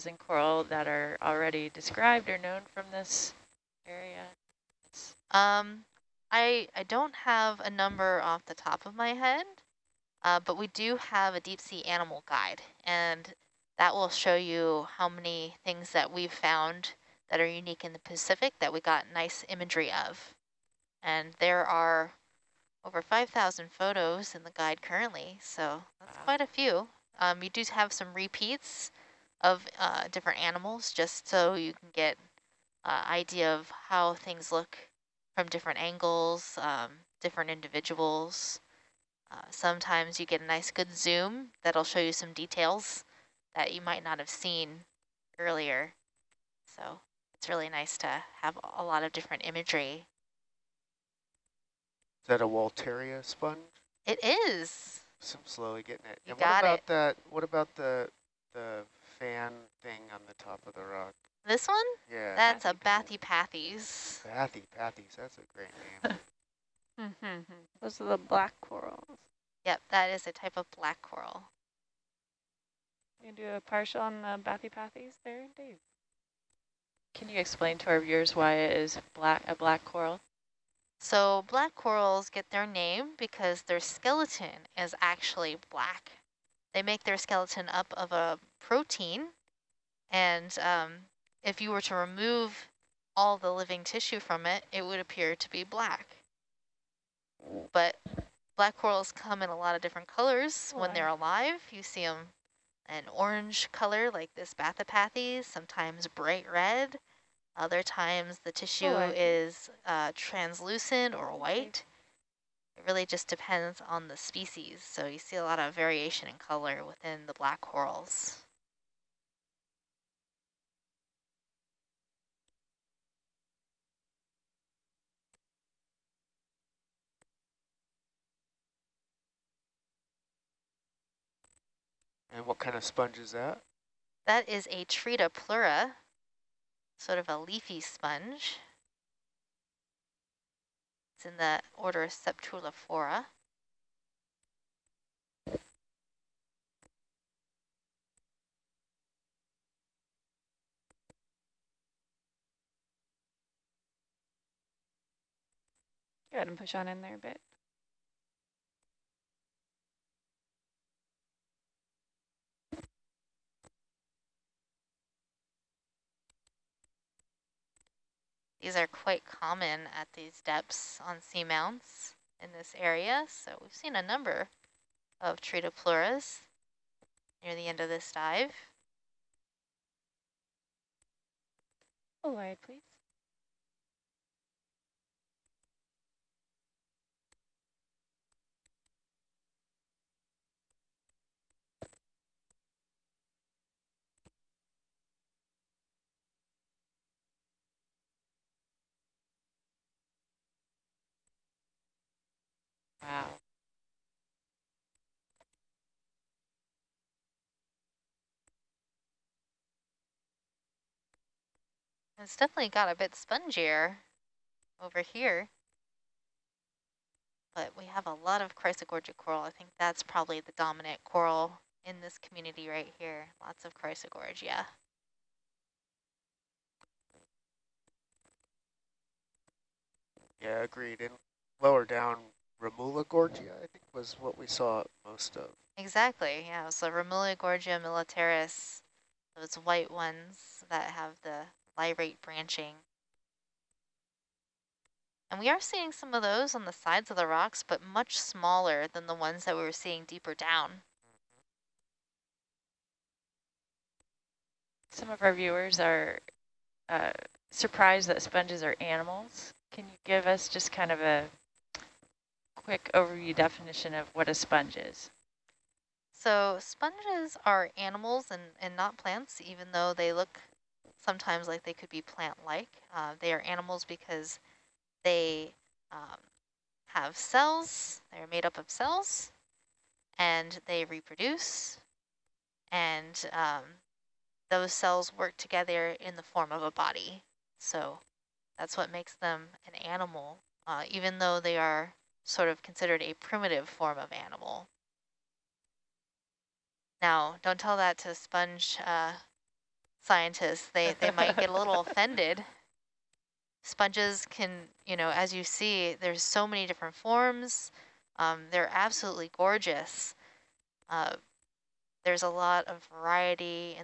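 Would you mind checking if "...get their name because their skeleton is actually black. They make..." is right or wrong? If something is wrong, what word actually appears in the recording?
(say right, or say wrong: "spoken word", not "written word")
right.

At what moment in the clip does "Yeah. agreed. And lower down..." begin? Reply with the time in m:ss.
3:50.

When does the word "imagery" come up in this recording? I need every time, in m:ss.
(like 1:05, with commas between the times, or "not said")
0:19, 0:49.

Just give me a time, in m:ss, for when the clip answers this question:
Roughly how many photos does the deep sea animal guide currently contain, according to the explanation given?
0:22.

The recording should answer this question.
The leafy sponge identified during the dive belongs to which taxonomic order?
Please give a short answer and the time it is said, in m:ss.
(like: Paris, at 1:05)
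Sceptrulophora, at 2:22.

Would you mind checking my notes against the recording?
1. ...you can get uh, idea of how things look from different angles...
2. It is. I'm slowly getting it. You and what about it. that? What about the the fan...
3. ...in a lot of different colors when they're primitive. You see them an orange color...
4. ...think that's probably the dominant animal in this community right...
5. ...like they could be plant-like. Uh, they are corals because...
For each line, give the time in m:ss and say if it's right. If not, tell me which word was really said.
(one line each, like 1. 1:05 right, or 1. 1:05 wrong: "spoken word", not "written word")
1. 0:31 right
2. 0:54 right
3. 1:39 wrong: "alive", not "primitive"
4. 3:39 wrong: "coral", not "animal"
5. 4:31 wrong: "animals", not "corals".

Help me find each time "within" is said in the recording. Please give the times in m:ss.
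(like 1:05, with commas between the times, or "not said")
1:56.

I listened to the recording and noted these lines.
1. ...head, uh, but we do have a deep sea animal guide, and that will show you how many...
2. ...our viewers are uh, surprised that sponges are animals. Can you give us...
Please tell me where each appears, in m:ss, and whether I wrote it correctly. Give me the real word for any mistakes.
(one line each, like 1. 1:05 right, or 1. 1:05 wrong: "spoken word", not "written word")
1. 0:09 right
2. 4:15 right.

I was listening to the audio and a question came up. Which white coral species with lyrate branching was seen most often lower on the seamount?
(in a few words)
Remula gorgia militaris.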